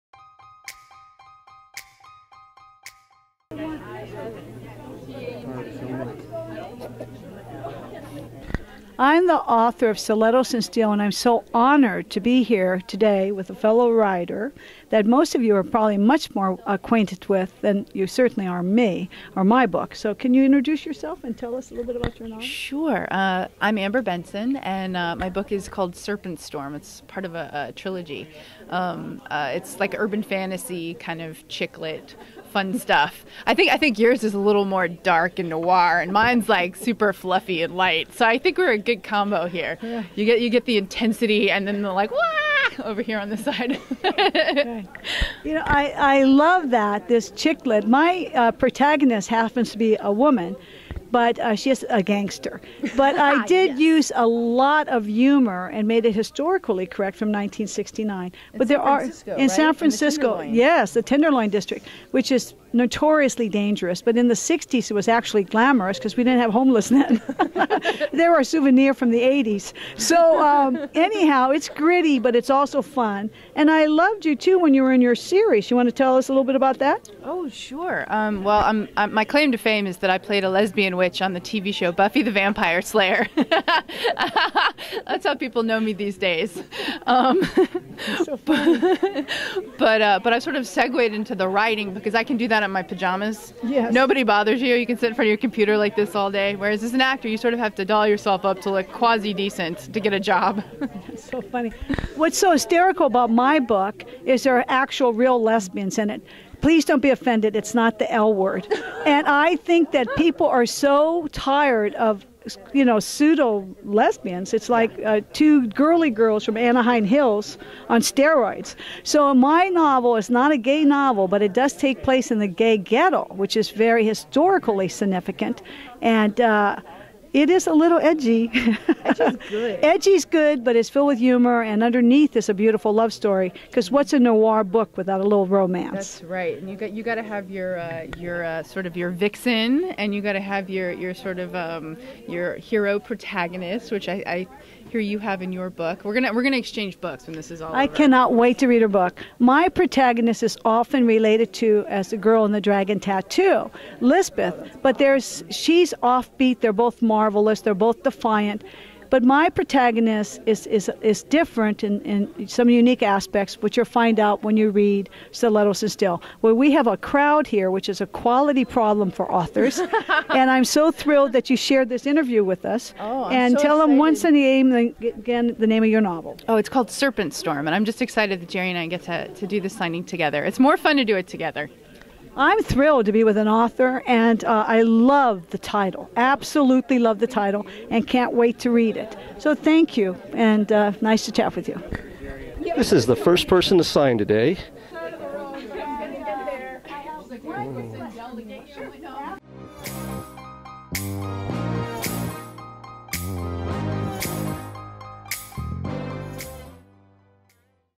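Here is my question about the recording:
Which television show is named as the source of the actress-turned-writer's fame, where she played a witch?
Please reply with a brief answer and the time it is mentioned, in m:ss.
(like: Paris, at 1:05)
Buffy the Vampire Slayer, at 1:21.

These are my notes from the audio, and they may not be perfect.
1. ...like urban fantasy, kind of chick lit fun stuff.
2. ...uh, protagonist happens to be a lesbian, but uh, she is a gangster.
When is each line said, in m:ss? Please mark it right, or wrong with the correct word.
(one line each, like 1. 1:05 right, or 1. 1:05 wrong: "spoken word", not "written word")
1. 0:29 right
2. 0:48 wrong: "woman", not "lesbian".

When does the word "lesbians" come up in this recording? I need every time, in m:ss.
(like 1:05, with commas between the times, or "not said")
1:20, 1:45, 1:53.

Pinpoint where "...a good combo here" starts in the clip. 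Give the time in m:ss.
0:38.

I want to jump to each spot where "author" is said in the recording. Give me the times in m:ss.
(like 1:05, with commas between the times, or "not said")
0:09, 2:49, 3:03.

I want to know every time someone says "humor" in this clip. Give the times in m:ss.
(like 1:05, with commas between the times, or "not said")
0:55, 2:11.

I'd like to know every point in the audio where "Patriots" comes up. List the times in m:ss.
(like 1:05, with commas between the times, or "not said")
not said.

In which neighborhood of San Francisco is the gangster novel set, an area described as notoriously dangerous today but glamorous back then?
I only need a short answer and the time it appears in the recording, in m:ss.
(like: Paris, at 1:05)
Tenderloin District, at 1:01.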